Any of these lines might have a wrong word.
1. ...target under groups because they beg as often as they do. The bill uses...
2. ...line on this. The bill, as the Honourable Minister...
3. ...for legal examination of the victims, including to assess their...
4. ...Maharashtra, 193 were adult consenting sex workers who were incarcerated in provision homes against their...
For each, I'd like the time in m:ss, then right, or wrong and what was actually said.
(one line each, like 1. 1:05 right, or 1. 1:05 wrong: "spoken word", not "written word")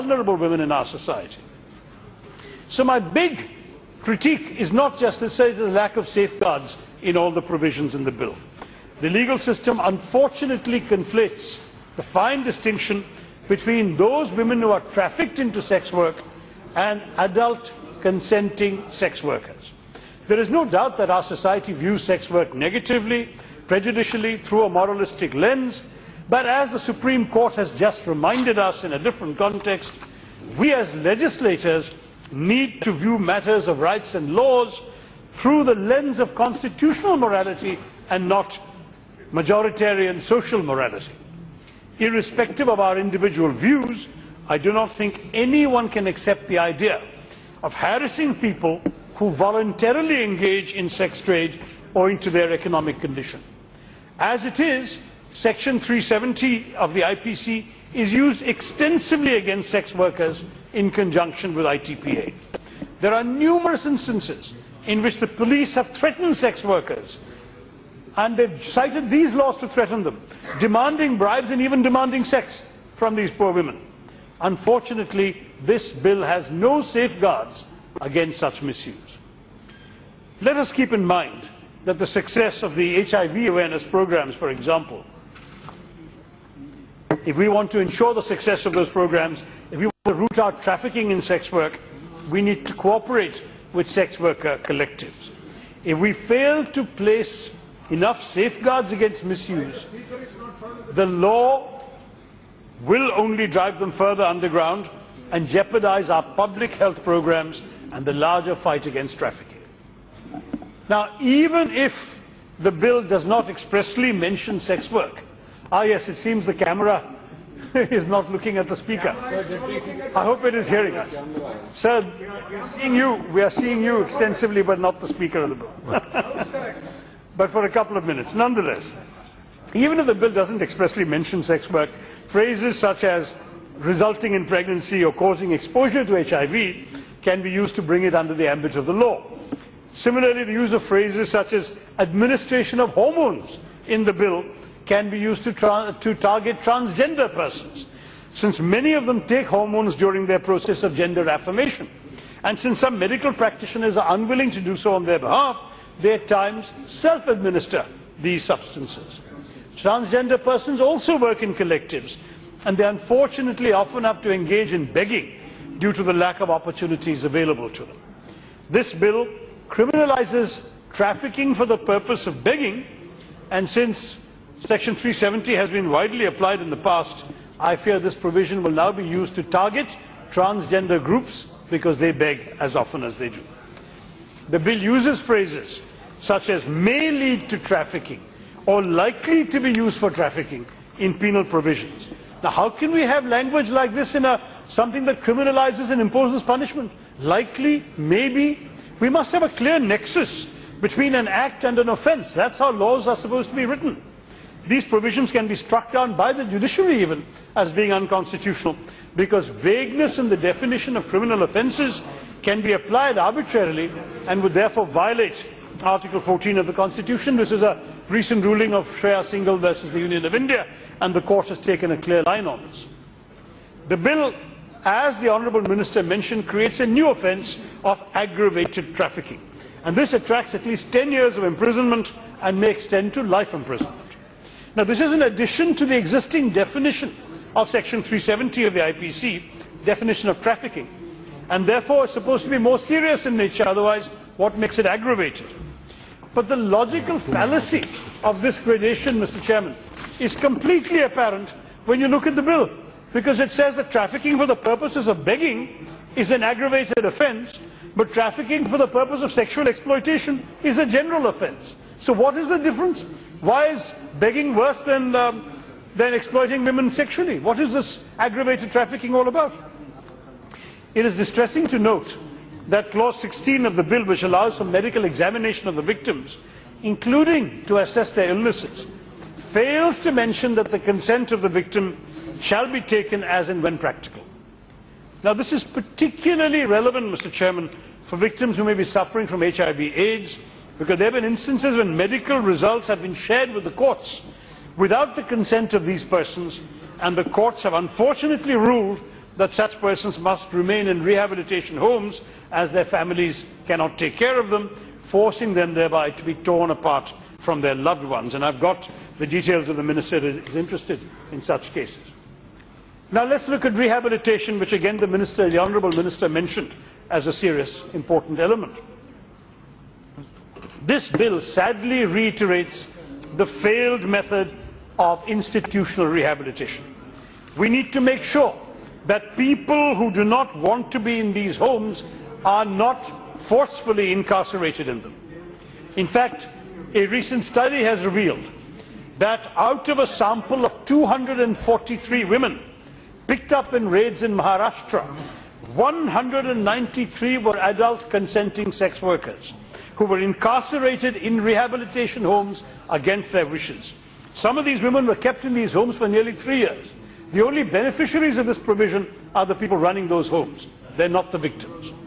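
1. 2:59 wrong: "transgender", not "under"
2. 3:42 right
3. 4:34 wrong: "medical", not "legal"
4. 5:44 wrong: "rehabilitation", not "provision".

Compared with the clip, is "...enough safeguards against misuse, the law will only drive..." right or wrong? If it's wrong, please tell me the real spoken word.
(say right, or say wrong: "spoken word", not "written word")
right.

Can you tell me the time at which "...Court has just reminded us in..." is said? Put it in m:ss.
0:27.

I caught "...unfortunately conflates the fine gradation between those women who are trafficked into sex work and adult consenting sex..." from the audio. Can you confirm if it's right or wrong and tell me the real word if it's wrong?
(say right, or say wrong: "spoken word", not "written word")
wrong: "distinction", not "gradation".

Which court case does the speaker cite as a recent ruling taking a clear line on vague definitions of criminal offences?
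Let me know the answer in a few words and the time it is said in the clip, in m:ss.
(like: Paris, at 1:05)
Shreya Singhal versus the Union of India, at 3:38.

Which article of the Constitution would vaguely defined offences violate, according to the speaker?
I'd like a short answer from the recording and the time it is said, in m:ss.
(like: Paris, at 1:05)
Article 14, at 3:35.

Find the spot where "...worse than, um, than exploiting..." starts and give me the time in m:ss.
4:24.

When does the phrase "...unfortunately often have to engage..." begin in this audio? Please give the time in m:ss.
2:42.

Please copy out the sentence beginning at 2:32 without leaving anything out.
And since some medical practitioners are unwilling to do so on their behalf, they at times self-administer these substances.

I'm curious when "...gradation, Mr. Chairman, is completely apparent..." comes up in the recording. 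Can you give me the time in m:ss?
4:08.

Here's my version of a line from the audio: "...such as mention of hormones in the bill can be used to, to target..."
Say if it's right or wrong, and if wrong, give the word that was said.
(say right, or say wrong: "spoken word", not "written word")
wrong: "administration", not "mention".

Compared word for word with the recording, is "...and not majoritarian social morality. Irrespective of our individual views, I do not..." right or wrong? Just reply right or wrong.
right.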